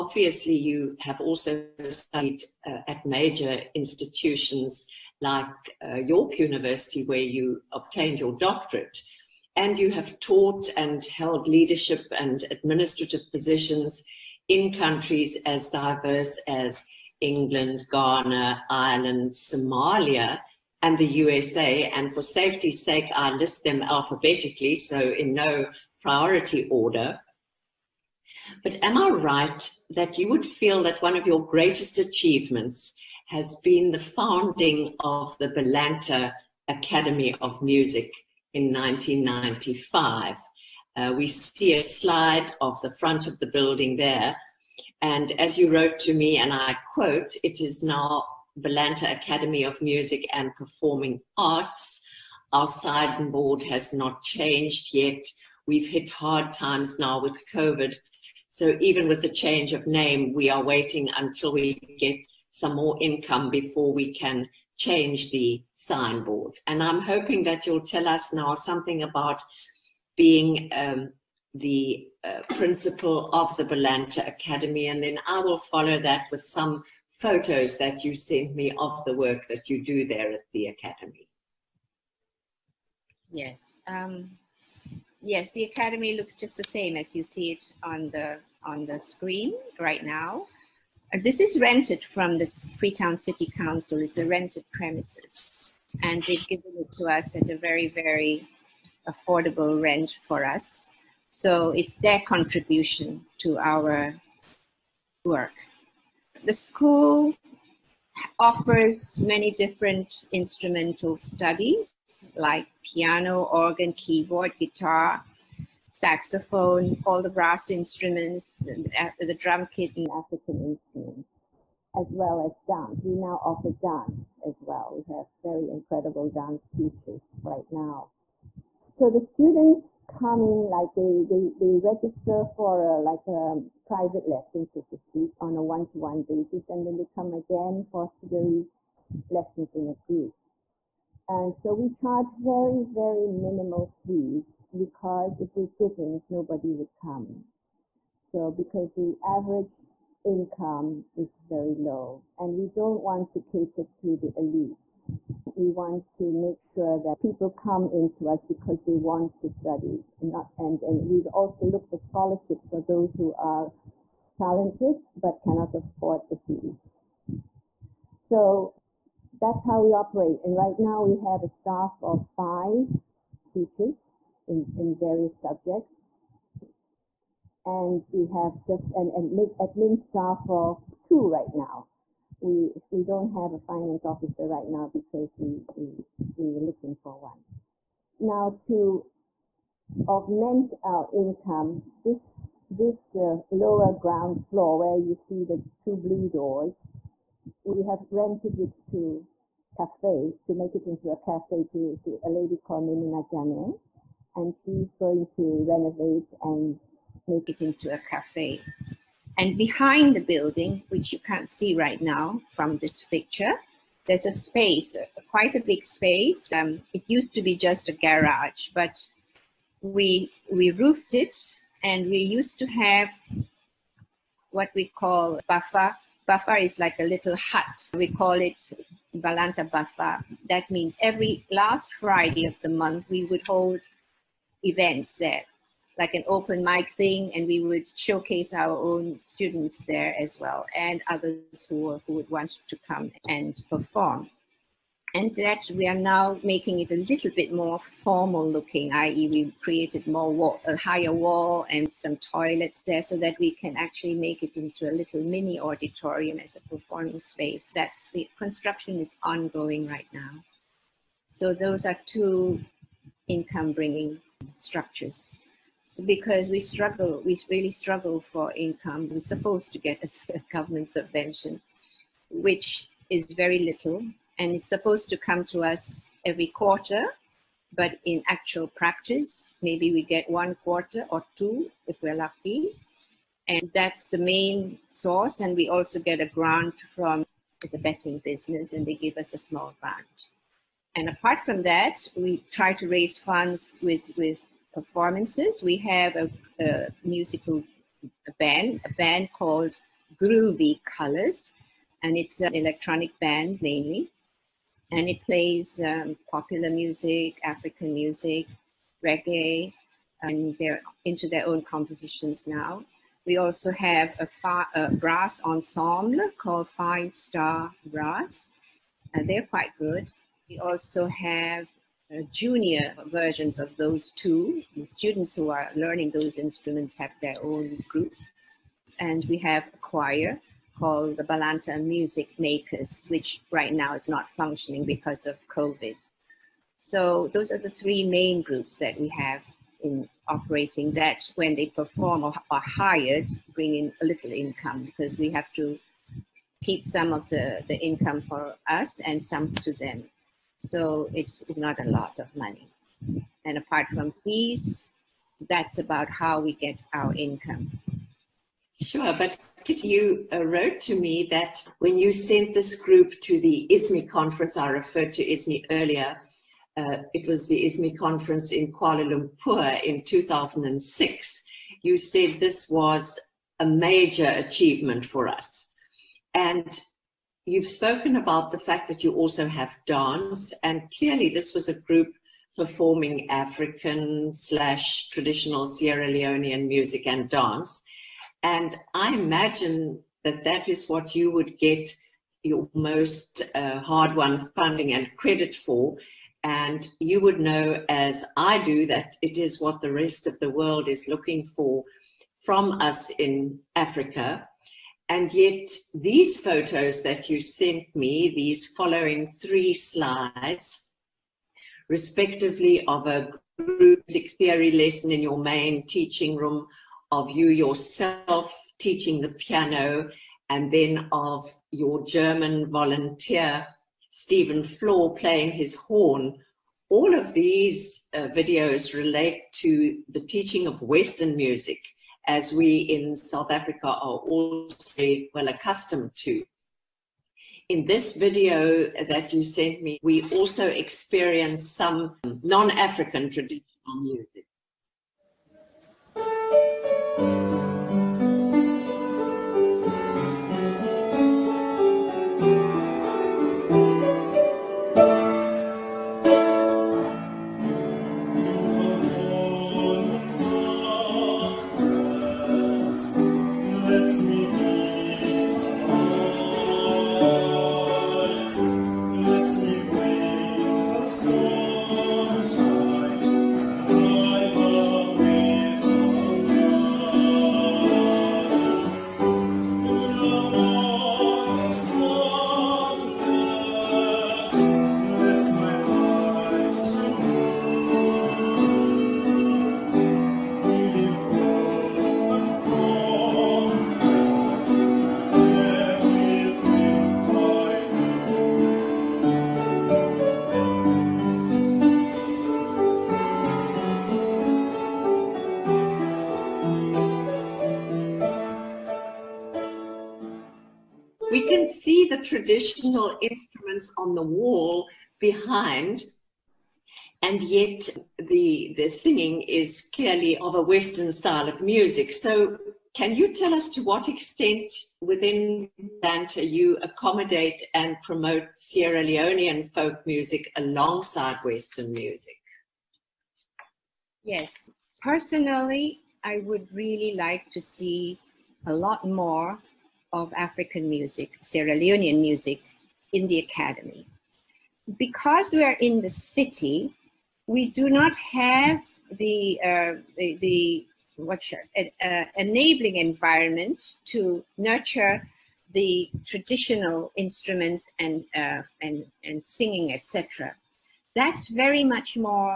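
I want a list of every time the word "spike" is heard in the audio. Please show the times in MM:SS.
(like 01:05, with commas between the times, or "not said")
not said.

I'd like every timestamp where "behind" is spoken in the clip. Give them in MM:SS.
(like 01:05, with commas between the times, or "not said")
03:29, 08:35.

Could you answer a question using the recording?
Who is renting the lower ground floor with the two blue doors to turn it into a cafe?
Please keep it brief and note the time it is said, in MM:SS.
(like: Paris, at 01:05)
Nemuna Jane, at 03:22.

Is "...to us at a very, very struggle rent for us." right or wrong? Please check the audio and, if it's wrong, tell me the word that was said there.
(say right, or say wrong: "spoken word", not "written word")
wrong: "affordable", not "struggle".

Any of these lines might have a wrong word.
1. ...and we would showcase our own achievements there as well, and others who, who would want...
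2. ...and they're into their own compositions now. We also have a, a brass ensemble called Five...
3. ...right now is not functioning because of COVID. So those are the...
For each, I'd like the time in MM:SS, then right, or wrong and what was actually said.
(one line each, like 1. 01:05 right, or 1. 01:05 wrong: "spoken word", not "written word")
1. 03:57 wrong: "students", not "achievements"
2. 05:10 right
3. 05:33 right.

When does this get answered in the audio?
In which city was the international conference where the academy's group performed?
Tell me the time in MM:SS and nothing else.
06:08.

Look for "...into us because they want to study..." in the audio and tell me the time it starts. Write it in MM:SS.
02:37.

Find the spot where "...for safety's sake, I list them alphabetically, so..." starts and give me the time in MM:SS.
00:22.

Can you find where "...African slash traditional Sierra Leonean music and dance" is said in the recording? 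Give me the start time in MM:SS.
06:23.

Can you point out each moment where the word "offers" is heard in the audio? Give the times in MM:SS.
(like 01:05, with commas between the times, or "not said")
01:48, 02:03.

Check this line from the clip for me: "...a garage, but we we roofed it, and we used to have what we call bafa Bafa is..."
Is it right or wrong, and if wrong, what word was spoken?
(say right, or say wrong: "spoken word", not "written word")
right.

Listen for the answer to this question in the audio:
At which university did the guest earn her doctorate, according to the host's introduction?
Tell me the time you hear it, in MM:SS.
00:05.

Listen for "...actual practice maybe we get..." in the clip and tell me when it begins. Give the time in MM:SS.
04:38.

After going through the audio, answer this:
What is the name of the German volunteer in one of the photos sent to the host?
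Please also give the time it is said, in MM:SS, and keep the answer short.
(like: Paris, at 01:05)
Stephen Floor, at 07:04.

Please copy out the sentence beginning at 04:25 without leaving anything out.
So because we struggle, we really struggle for income.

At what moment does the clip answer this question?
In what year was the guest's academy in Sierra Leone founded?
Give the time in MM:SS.
00:38.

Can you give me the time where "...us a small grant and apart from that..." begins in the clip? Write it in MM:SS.
04:49.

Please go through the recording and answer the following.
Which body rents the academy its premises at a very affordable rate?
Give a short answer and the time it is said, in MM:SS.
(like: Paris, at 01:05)
Freetown City Council, at 01:32.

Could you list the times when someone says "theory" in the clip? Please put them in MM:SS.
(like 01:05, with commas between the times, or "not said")
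02:18, 06:54.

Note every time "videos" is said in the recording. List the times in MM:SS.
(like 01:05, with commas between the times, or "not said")
07:08, 07:18.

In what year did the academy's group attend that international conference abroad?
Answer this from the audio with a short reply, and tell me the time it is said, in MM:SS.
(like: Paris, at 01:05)
2006, at 06:10.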